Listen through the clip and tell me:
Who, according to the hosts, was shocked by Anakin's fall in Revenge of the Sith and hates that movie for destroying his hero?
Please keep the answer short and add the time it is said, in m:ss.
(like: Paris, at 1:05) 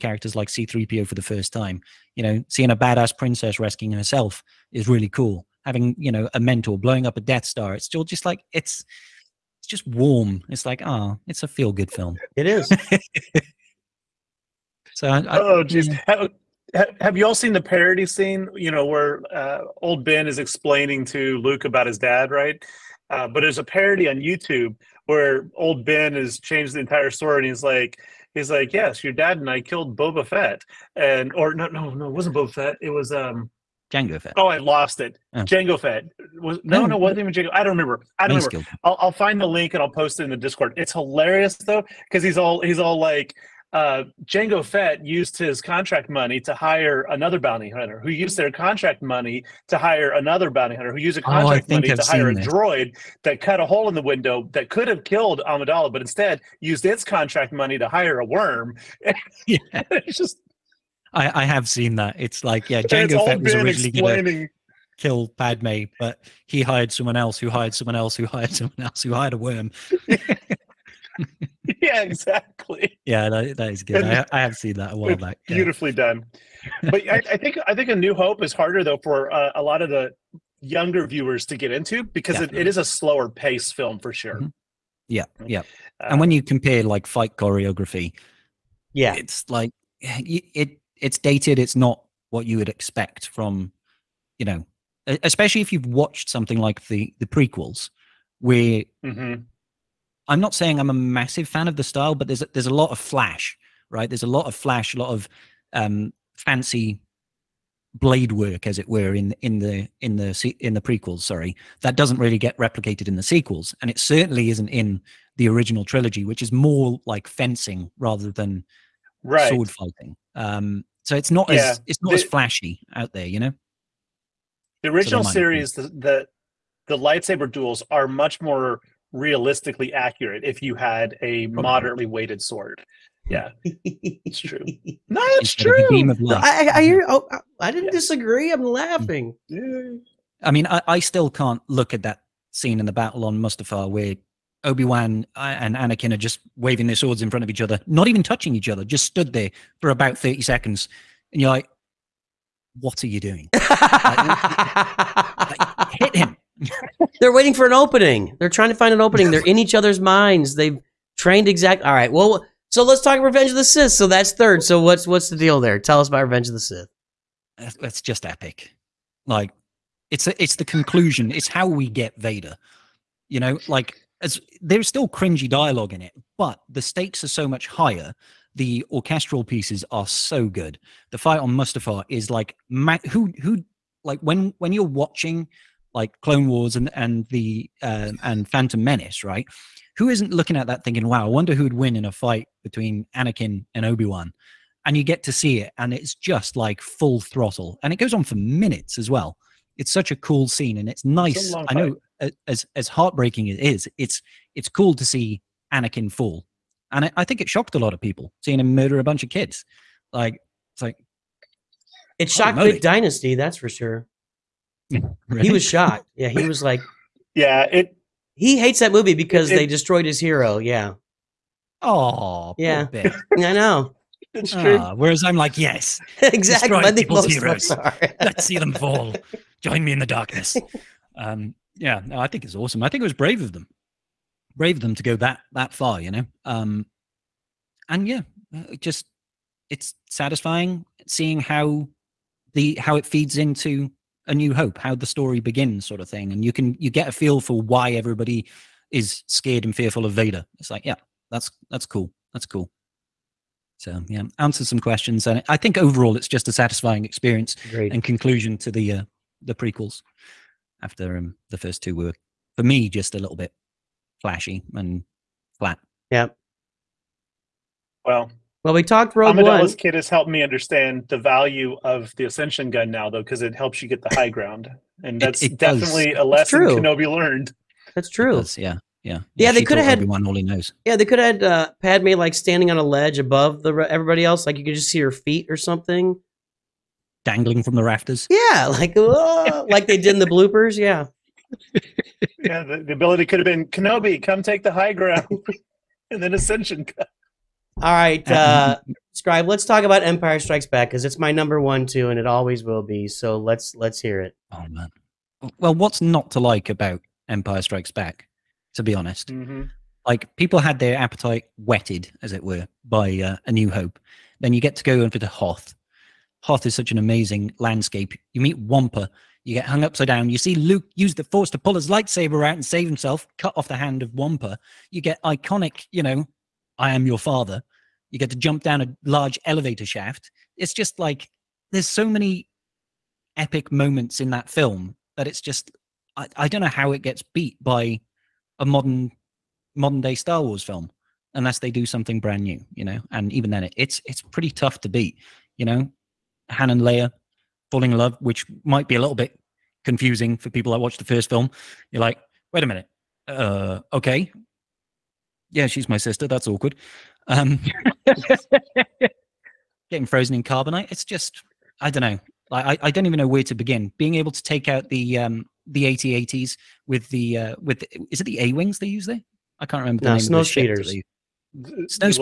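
The Dynasty, at 3:32.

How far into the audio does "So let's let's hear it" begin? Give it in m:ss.
5:03.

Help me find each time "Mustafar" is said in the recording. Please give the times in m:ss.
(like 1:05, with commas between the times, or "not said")
2:23, 3:01.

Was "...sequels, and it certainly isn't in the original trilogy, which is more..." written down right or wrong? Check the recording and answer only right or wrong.
right.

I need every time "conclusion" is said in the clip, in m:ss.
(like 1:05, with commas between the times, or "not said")
2:50, 4:18.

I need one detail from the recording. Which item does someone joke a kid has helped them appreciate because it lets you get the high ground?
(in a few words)
Ascension gun.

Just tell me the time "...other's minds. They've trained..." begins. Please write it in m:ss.
2:39.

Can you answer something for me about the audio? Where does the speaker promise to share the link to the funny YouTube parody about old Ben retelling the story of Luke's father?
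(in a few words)
Discord.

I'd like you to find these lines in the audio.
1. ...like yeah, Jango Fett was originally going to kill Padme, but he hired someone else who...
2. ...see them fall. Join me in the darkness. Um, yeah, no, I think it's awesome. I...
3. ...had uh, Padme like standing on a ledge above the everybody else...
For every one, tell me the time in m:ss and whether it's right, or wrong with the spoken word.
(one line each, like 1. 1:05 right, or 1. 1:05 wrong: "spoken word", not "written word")
1. 1:02 right
2. 3:48 right
3. 4:41 right.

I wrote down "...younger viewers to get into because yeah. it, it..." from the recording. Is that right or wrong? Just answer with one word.
right.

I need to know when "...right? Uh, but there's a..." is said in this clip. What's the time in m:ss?
0:22.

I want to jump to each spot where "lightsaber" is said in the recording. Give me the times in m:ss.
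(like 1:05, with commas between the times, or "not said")
2:06, 5:21.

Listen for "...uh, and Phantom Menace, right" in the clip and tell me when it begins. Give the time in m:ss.
3:07.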